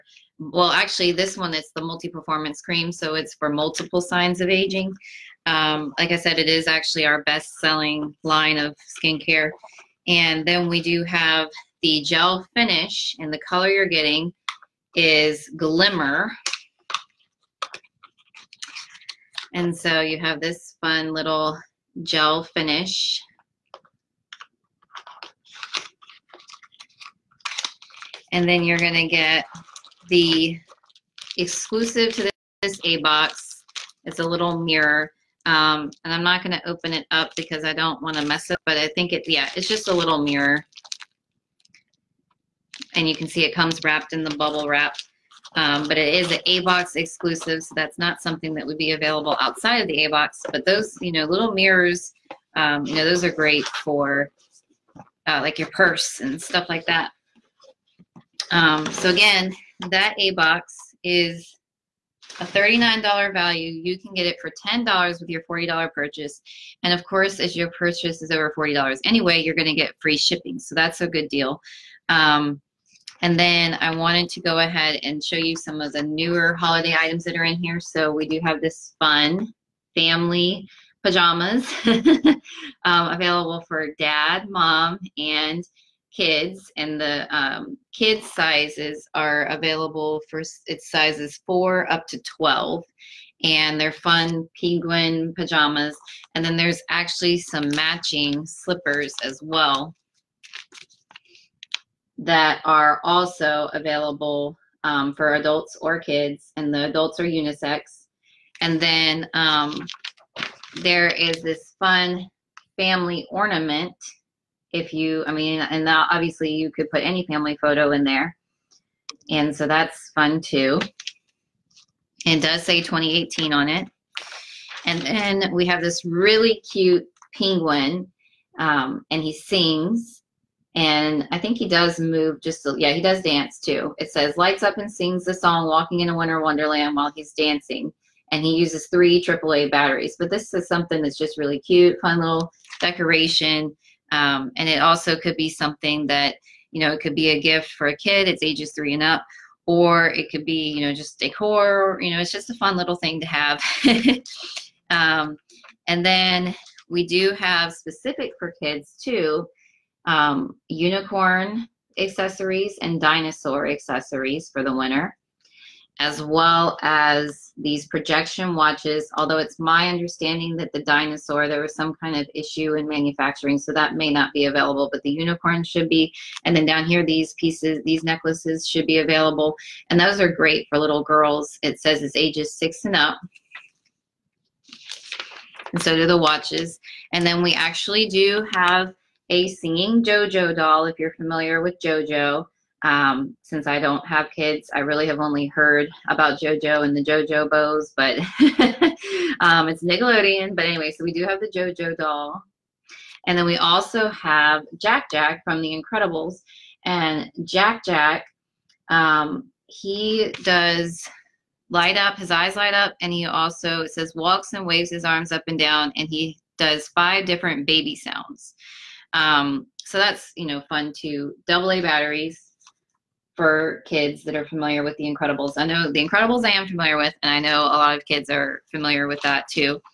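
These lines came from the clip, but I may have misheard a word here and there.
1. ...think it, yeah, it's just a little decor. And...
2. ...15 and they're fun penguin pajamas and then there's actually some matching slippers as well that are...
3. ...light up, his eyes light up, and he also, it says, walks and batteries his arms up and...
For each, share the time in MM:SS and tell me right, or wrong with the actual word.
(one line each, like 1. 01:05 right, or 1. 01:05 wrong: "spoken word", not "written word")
1. 00:38 wrong: "mirror", not "decor"
2. 01:32 wrong: "12", not "15"
3. 03:31 wrong: "waves", not "batteries".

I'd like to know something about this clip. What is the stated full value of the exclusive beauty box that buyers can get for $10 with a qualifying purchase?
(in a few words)
$39.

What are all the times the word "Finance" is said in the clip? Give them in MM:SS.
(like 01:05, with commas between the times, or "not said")
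not said.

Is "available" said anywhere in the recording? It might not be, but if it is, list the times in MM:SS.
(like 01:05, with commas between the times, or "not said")
00:48, 01:23, 01:29, 01:43, 02:54, 02:58.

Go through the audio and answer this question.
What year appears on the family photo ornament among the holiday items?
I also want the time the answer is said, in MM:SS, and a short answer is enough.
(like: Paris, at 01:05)
2018, at 02:02.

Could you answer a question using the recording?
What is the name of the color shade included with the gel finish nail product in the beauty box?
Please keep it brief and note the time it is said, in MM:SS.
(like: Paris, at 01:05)
Glimmer, at 00:15.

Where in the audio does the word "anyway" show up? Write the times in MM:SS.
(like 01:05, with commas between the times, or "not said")
01:09, 03:20.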